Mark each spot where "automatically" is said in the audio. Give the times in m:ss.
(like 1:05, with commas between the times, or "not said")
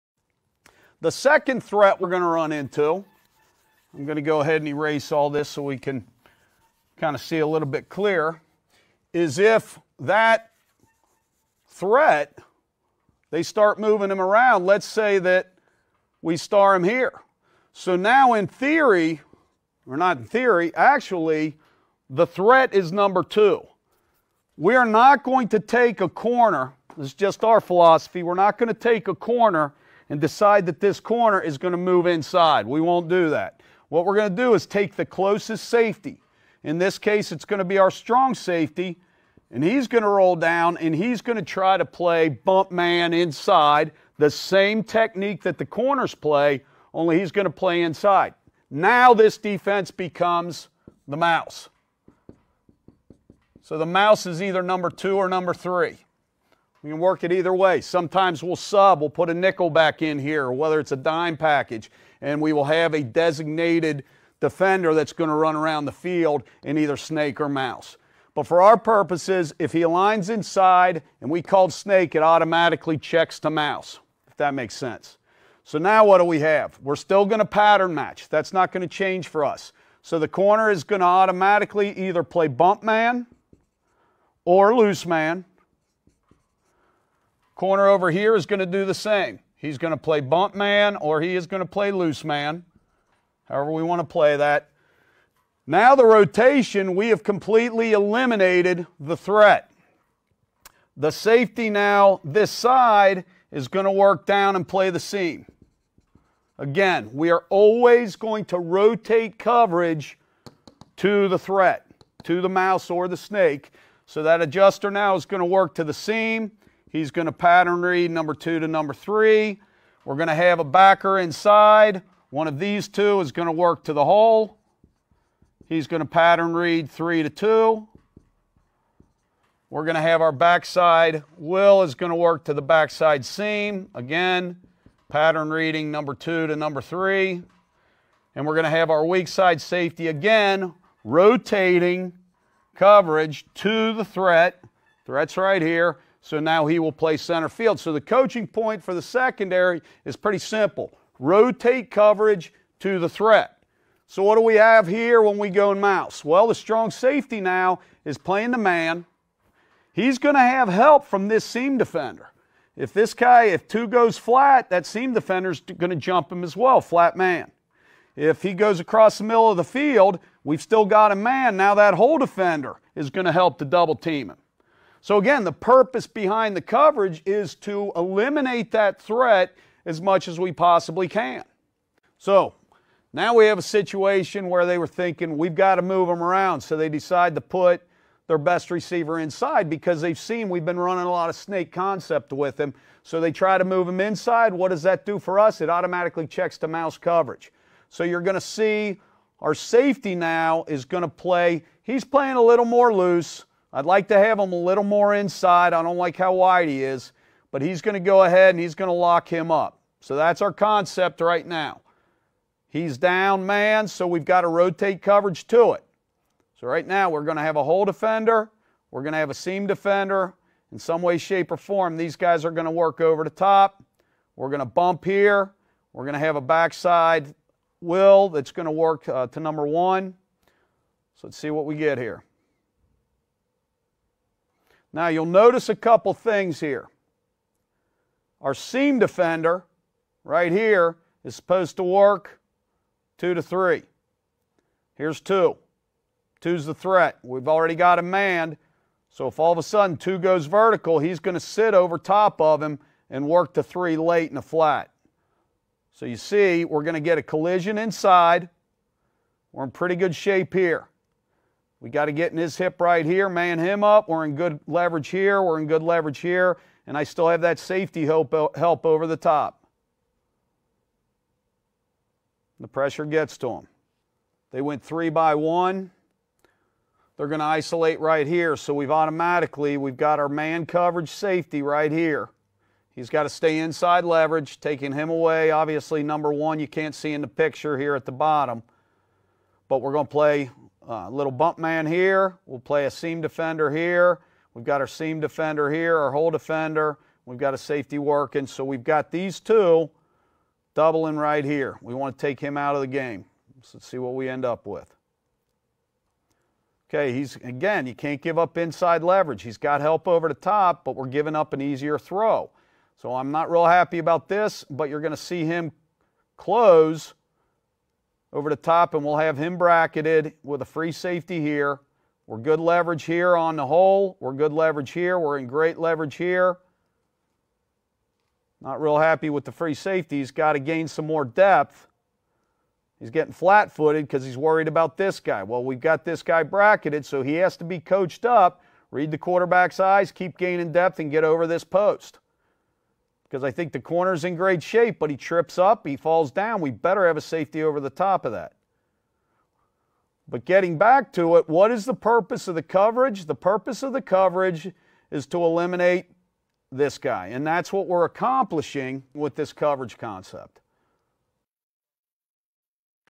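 1:12, 1:21, 3:15, 4:38.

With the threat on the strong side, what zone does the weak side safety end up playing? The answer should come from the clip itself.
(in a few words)
center field.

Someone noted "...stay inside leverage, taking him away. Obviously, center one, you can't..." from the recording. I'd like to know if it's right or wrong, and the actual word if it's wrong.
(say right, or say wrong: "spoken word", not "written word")
wrong: "number", not "center".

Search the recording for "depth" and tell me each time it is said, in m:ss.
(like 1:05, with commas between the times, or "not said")
5:31, 5:40.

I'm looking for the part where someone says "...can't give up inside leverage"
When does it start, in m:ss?
5:07.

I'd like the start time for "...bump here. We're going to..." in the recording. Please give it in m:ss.
3:44.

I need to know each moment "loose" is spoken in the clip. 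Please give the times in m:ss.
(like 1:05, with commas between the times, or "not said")
1:24, 1:31, 3:22.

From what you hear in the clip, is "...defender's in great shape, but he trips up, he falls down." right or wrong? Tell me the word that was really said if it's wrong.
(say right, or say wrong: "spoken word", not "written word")
wrong: "corner", not "defender".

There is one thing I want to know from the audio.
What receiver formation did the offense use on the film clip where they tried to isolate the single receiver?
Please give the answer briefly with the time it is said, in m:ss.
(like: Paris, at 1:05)
three by one, at 4:34.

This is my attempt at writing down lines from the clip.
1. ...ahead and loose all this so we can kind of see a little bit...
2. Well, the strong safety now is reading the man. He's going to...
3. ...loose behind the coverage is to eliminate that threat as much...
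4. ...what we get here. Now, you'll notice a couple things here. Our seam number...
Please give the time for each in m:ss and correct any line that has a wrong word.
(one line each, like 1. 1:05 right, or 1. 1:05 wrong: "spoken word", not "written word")
1. 0:04 wrong: "erase", not "loose"
2. 2:36 wrong: "playing", not "reading"
3. 2:55 wrong: "purpose", not "loose"
4. 3:51 wrong: "defender", not "number".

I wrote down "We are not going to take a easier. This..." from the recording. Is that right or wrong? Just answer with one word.
wrong.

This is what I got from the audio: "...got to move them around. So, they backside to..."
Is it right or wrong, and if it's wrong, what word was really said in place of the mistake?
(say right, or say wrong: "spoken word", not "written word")
wrong: "decide", not "backside".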